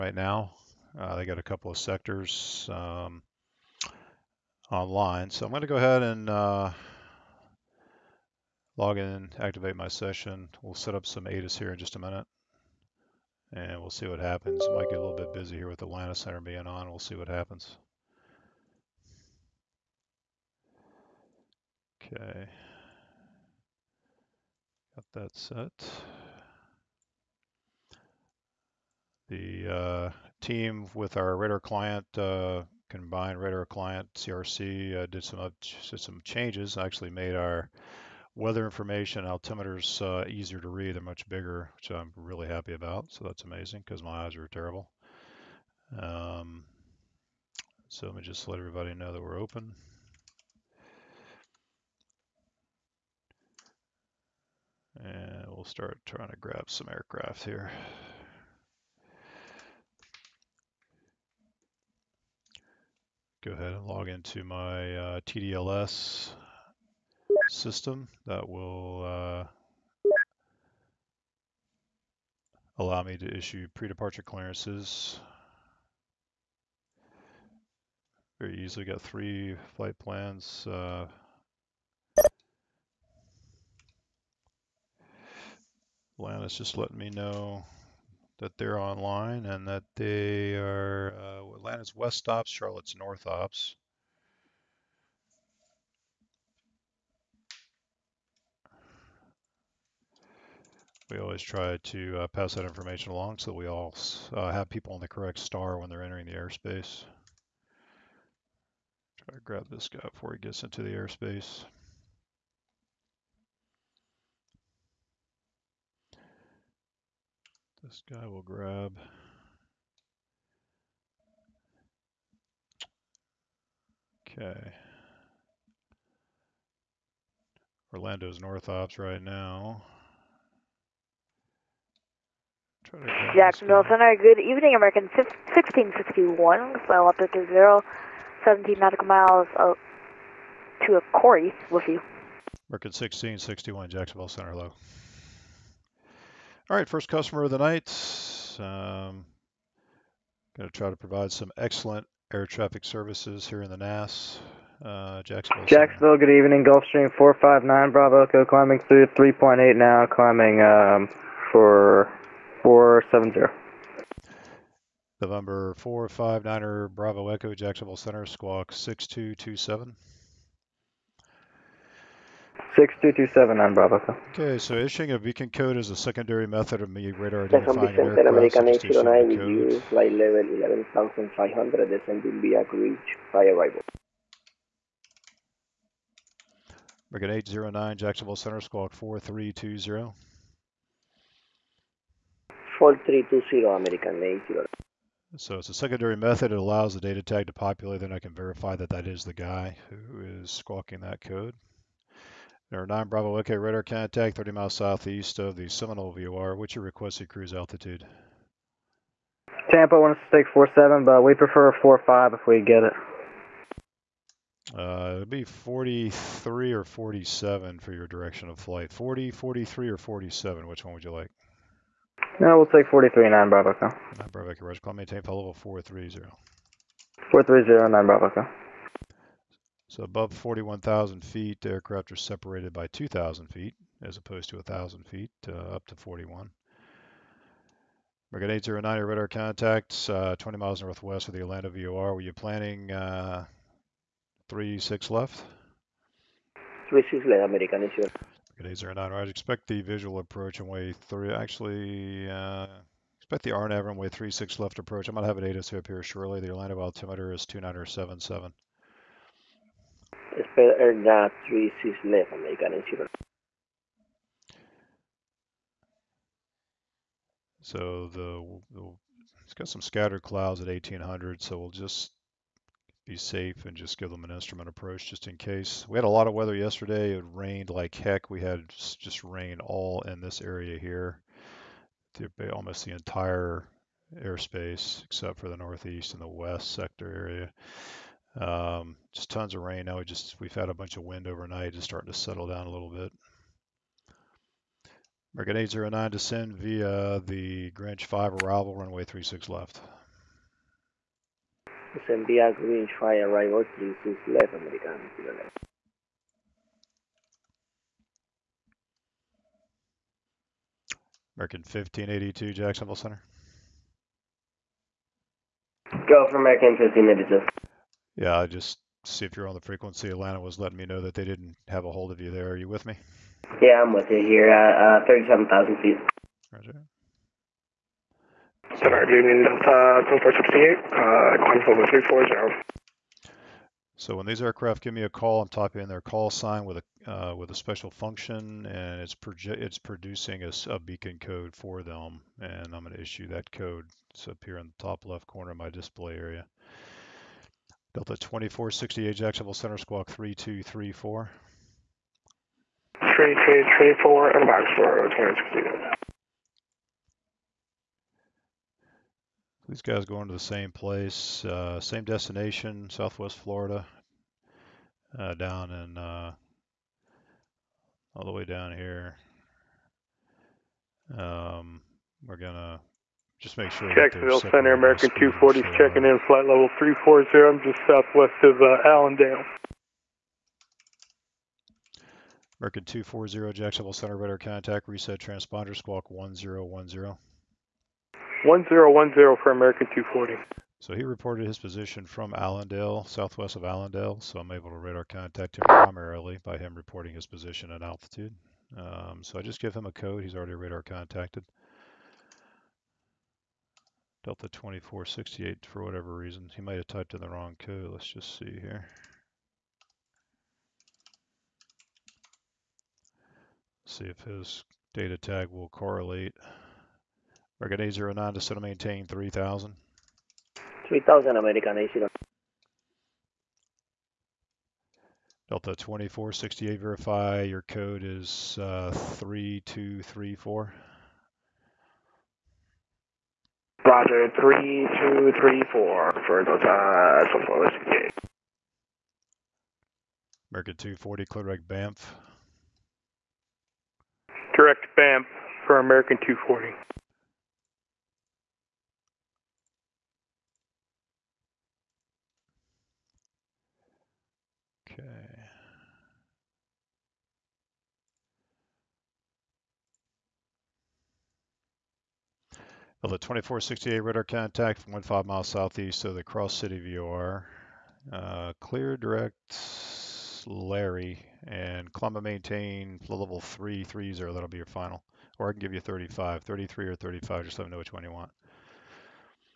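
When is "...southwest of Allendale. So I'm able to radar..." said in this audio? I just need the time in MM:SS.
06:33.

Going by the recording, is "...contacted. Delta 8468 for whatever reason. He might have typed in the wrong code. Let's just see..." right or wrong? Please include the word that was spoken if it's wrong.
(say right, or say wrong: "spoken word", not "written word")
wrong: "2468", not "8468".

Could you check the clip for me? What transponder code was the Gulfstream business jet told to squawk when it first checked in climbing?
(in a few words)
6227.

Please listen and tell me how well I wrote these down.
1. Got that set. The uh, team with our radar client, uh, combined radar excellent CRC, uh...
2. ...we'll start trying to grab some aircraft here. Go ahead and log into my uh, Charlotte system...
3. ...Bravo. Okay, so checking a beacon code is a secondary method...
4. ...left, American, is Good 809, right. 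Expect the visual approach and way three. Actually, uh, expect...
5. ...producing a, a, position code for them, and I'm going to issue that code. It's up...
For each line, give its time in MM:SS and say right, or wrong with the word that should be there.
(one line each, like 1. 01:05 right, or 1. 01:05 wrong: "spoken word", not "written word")
1. 00:24 wrong: "client", not "excellent"
2. 00:55 wrong: "TDLS", not "Charlotte"
3. 02:53 wrong: "issuing", not "checking"
4. 04:07 right
5. 05:39 wrong: "beacon", not "position".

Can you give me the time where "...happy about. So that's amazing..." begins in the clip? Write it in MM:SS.
00:42.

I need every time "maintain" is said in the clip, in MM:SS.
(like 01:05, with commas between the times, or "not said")
03:44, 06:58, 07:52.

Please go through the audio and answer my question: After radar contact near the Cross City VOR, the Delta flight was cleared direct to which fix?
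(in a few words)
Larry.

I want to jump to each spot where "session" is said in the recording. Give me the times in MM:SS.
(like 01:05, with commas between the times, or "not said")
00:09.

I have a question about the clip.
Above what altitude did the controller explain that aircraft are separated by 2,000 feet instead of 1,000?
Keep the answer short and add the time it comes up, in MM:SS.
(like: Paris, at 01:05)
41,000 feet, at 03:50.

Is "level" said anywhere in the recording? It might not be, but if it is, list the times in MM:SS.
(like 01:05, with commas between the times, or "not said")
03:00, 03:45, 06:16, 07:53.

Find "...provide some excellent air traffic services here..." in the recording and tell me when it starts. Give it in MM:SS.
02:30.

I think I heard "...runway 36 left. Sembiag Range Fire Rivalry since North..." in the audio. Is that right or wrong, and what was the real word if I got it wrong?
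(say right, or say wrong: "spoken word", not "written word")
right.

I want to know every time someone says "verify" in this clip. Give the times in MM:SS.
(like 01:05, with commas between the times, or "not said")
03:18, 07:06.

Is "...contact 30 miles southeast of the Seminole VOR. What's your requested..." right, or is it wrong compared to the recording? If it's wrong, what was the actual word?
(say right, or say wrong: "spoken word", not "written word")
right.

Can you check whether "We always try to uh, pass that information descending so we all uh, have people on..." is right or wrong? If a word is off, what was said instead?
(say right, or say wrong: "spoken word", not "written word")
wrong: "along", not "descending".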